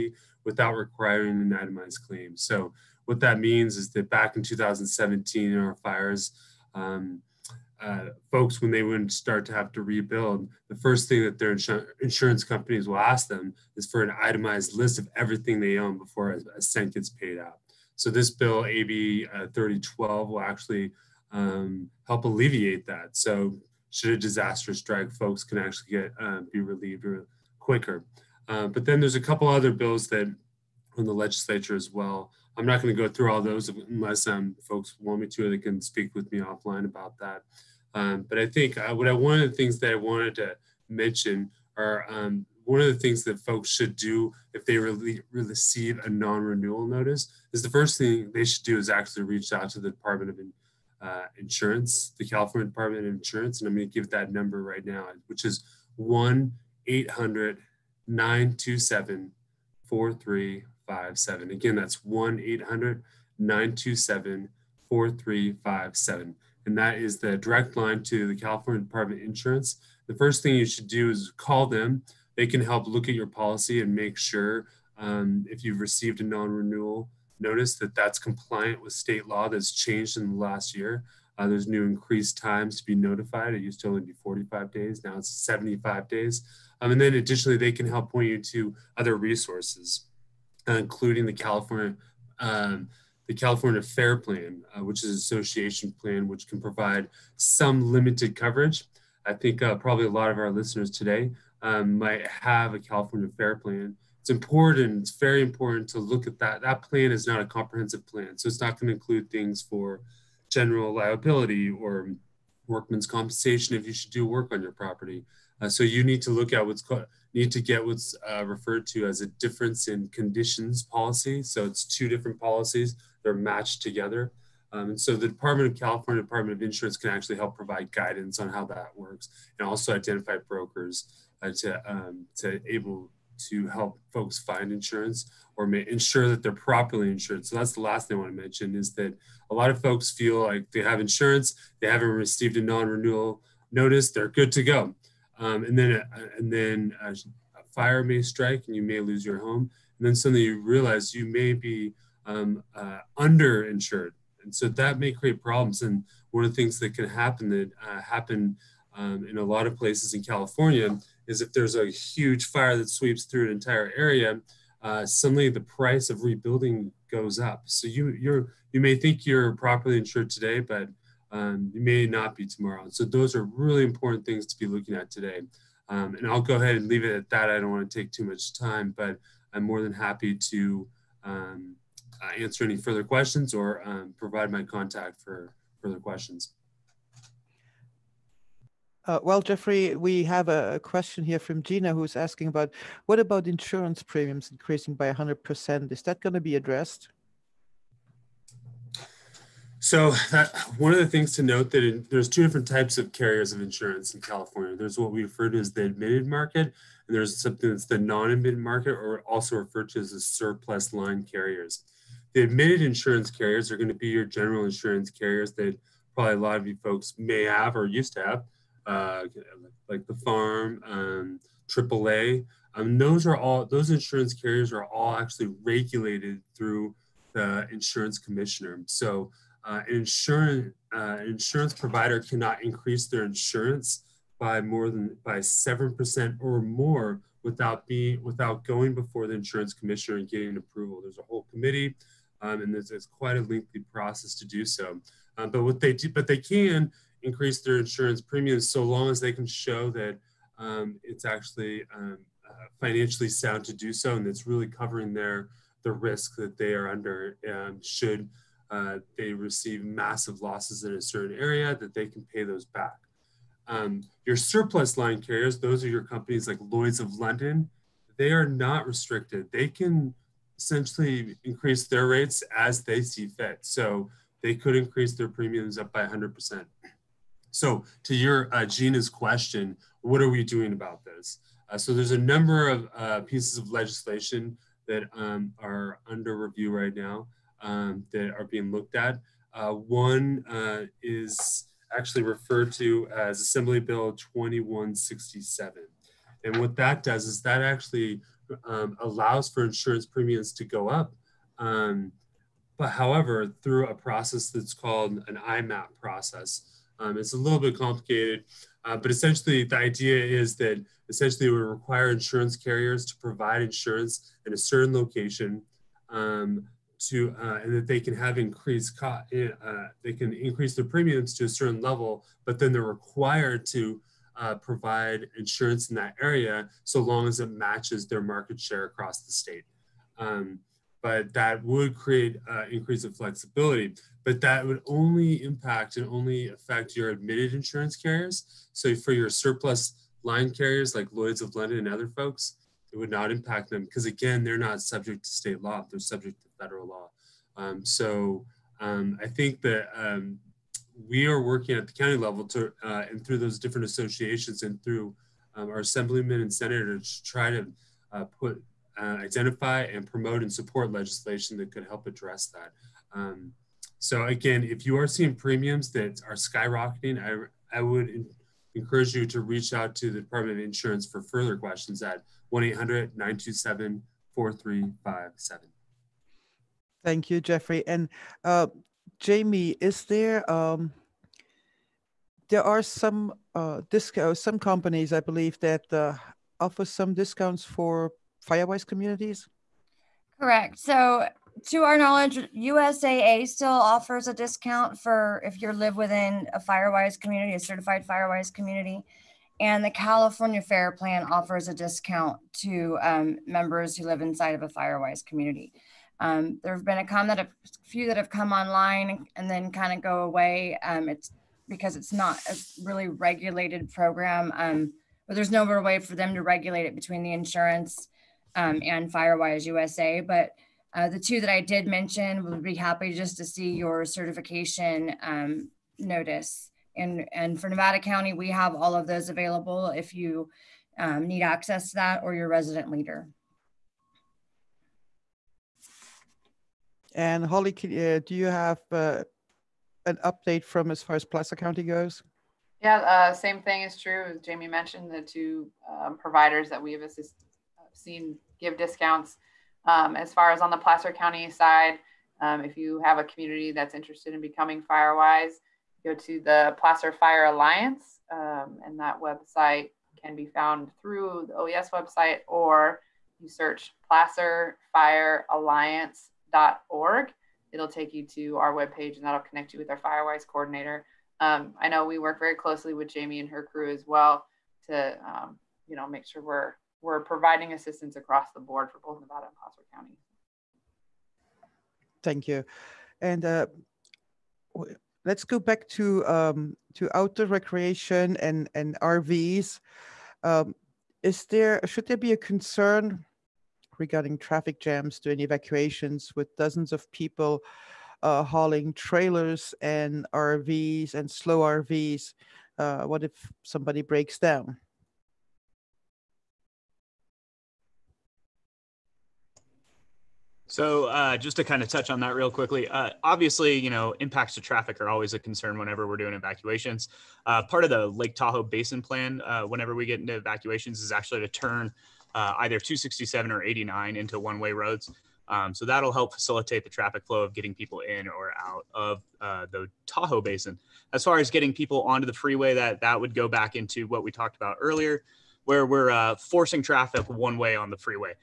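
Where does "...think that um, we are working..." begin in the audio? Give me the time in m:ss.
5:49.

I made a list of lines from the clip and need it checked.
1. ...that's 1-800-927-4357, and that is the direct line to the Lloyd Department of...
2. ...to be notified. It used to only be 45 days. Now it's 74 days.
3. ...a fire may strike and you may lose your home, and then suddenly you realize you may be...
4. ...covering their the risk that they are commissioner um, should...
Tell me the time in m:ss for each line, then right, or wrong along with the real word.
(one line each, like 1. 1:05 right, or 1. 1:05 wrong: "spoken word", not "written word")
1. 1:01 wrong: "California", not "Lloyd"
2. 1:22 wrong: "75", not "74"
3. 2:27 right
4. 4:14 wrong: "under", not "commissioner".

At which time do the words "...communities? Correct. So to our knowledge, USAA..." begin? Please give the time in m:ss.
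6:28.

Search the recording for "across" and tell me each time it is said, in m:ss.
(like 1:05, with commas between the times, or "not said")
5:28, 7:58.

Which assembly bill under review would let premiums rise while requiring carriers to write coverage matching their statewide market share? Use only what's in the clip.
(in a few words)
Assembly Bill 2167.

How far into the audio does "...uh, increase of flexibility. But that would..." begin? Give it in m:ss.
5:32.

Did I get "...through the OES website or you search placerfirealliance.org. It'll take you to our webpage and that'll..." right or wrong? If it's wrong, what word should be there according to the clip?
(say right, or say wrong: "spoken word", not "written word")
right.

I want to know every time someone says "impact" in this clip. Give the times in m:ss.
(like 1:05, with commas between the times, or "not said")
5:35, 5:43, 8:34.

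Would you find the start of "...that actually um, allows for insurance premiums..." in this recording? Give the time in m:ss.
4:57.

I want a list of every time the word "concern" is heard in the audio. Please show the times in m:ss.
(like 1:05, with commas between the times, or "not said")
8:12, 8:35.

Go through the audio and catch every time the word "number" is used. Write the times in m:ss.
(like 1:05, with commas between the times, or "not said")
0:54, 4:42.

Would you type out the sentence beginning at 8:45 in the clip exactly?
Um, so that'll help facilitate the traffic flow of getting people in or out of uh, the Tahoe Basin.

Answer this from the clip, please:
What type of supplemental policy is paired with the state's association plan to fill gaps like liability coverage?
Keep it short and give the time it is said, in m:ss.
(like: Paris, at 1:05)
difference in conditions policy, at 1:59.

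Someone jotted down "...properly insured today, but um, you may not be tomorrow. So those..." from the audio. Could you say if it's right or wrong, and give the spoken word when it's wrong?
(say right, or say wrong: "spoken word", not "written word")
right.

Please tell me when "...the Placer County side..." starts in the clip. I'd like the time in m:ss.
7:30.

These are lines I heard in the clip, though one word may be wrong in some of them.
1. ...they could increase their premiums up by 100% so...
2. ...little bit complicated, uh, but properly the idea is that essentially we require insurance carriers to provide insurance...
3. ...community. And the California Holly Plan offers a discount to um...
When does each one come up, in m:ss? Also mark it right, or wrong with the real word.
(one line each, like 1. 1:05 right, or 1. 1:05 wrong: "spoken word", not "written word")
1. 4:34 right
2. 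5:07 wrong: "essentially", not "properly"
3. 6:38 wrong: "Fair", not "Holly".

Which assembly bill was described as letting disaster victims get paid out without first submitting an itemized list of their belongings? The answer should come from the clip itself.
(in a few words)
AB 3012.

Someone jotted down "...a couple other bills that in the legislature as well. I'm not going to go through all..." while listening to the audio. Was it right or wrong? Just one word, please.
right.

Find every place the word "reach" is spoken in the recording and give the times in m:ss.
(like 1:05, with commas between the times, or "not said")
0:49, 6:09.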